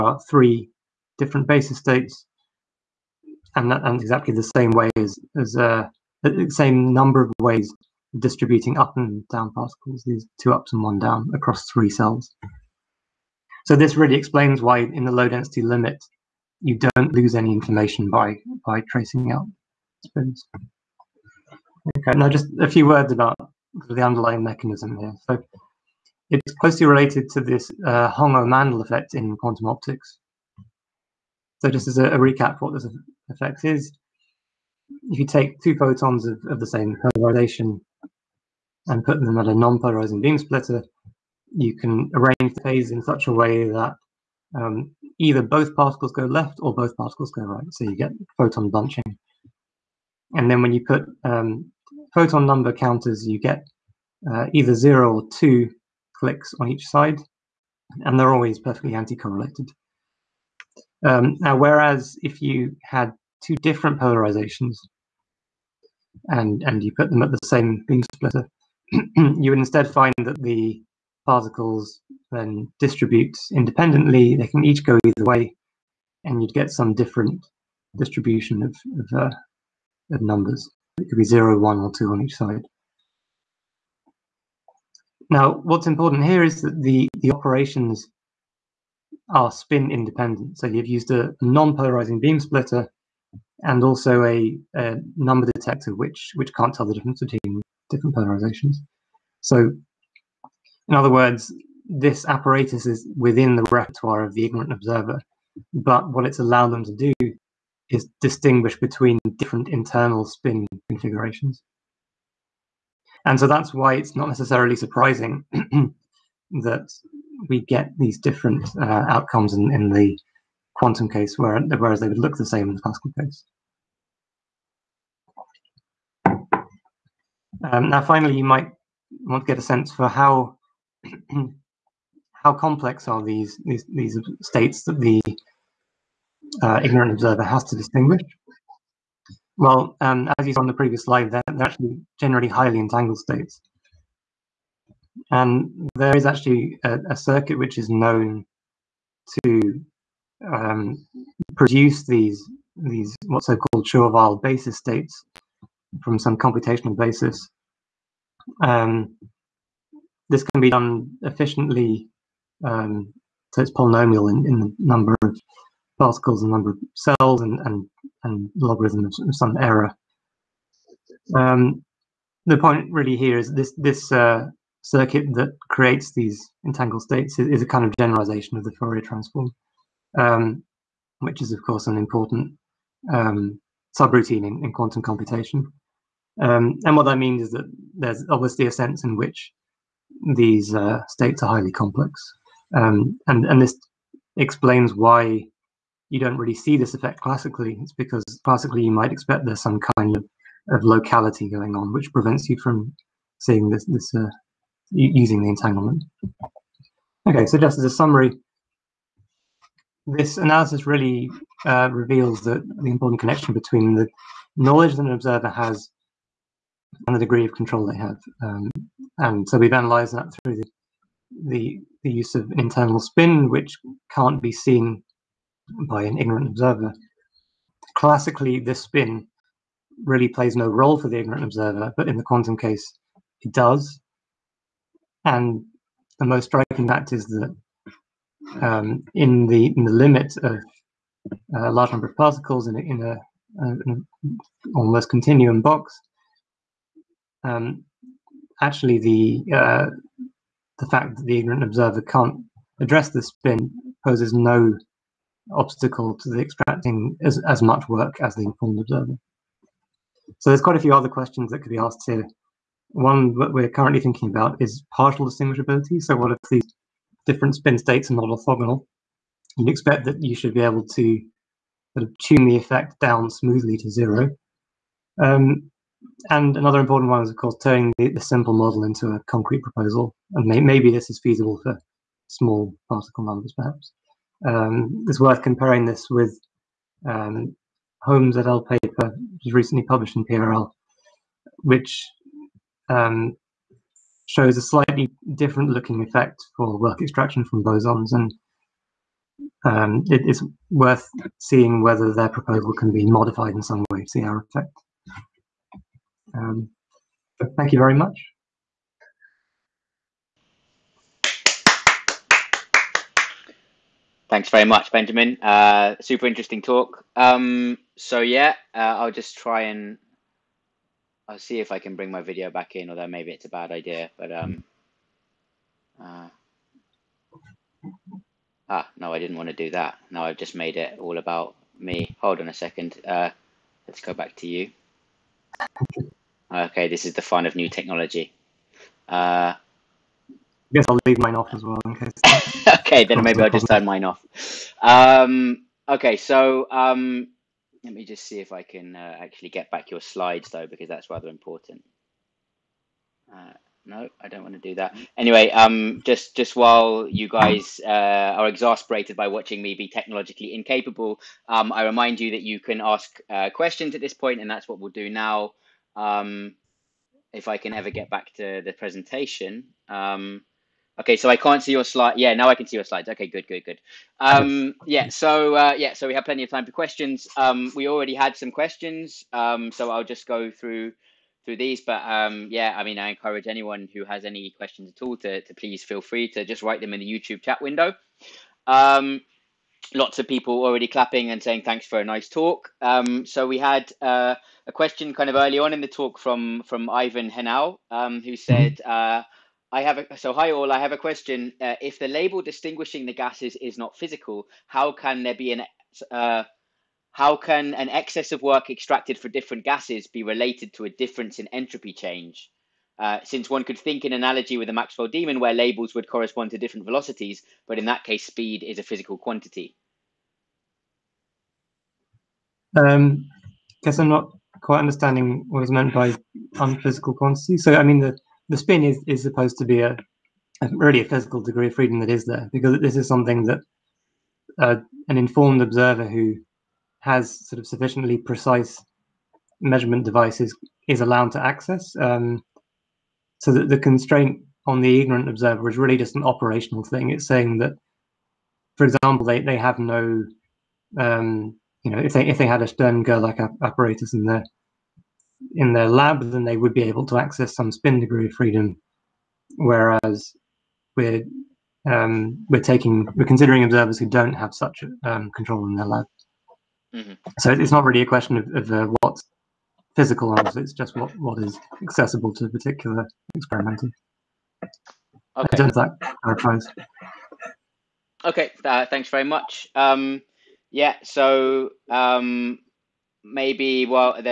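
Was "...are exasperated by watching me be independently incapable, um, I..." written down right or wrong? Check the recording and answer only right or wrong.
wrong.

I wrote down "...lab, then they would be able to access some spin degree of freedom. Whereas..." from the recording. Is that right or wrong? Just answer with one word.
right.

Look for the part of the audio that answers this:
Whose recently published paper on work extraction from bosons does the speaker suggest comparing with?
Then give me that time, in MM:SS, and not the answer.
04:48.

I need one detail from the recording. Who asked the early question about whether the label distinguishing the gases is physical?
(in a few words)
Ivan Henao.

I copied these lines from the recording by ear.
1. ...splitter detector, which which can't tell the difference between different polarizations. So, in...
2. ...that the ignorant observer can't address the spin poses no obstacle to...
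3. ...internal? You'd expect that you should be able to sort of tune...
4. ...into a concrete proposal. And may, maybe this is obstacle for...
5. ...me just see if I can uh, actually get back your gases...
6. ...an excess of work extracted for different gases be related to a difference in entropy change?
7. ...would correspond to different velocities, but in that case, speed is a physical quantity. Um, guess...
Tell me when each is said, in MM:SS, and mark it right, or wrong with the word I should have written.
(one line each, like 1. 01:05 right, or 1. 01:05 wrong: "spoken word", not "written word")
1. 01:35 wrong: "number", not "splitter"
2. 04:11 right
3. 04:28 wrong: "orthogonal", not "internal"
4. 04:38 wrong: "feasible", not "obstacle"
5. 05:47 wrong: "slides", not "gases"
6. 06:47 right
7. 06:55 right.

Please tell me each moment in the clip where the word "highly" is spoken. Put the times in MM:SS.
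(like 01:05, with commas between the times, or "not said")
02:22, 03:11.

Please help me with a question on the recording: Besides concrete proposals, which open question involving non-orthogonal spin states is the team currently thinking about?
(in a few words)
partial distinguishability.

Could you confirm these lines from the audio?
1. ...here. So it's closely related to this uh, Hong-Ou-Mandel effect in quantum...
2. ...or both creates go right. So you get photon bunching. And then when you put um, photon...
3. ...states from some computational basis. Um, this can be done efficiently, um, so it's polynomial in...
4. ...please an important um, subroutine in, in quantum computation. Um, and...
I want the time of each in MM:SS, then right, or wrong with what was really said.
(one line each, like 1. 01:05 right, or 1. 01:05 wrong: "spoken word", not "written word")
1. 00:24 right
2. 00:46 wrong: "particles", not "creates"
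3. 02:34 right
4. 03:01 wrong: "course", not "please".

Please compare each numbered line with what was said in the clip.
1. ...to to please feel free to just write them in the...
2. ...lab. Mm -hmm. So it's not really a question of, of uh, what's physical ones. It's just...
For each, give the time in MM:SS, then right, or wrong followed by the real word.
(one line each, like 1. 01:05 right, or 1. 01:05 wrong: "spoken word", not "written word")
1. 06:25 right
2. 07:45 right.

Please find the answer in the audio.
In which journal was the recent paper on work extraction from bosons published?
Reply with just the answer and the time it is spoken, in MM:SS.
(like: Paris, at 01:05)
PRL, at 04:50.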